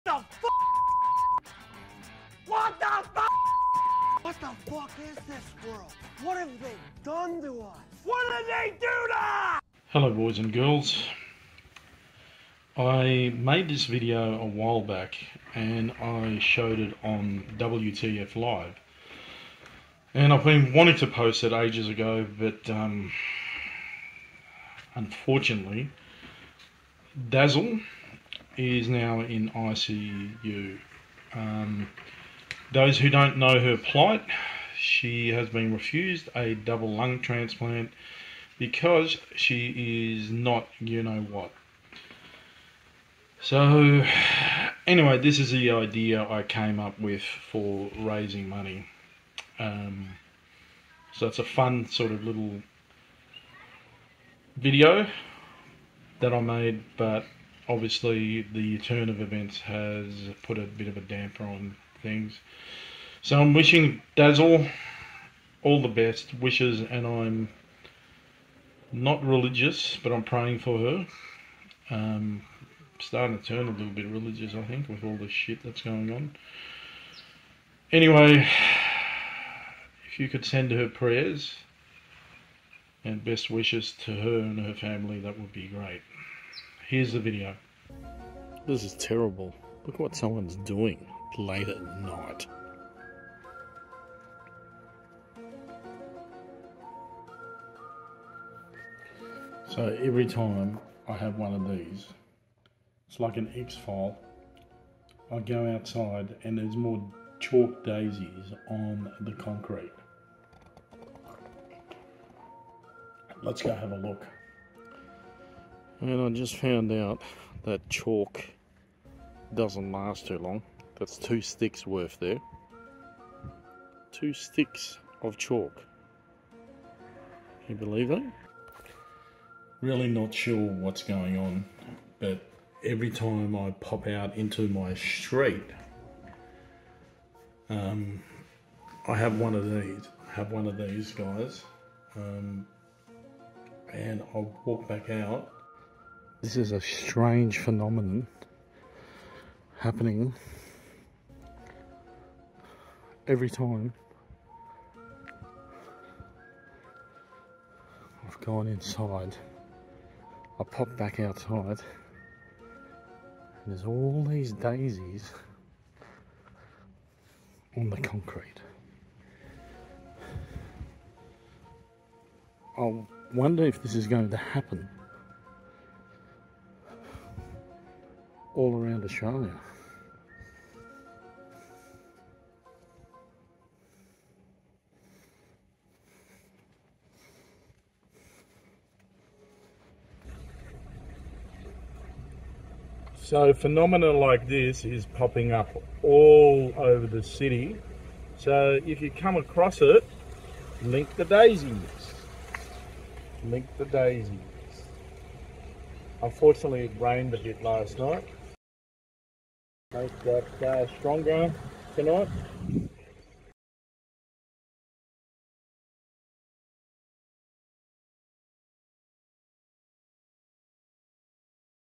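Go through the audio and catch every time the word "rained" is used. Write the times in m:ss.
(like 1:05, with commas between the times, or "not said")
3:26.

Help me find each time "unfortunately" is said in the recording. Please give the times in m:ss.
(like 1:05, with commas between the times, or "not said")
0:24, 3:26.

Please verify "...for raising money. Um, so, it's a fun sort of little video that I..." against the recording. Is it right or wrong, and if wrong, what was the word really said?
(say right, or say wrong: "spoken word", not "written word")
right.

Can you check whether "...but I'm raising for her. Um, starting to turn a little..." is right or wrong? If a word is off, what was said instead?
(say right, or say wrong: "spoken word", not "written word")
wrong: "praying", not "raising".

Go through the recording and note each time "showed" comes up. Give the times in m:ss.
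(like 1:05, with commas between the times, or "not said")
0:16.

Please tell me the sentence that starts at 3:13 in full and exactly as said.
So phenomena like this is popping up all over the city.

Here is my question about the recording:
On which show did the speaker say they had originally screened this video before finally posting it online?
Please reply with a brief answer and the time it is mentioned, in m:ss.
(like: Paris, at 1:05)
WTF Live, at 0:17.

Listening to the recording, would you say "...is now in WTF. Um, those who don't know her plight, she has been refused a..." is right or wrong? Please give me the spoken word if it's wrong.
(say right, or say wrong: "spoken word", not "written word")
wrong: "ICU", not "WTF".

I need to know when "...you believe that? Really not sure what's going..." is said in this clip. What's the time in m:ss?
2:07.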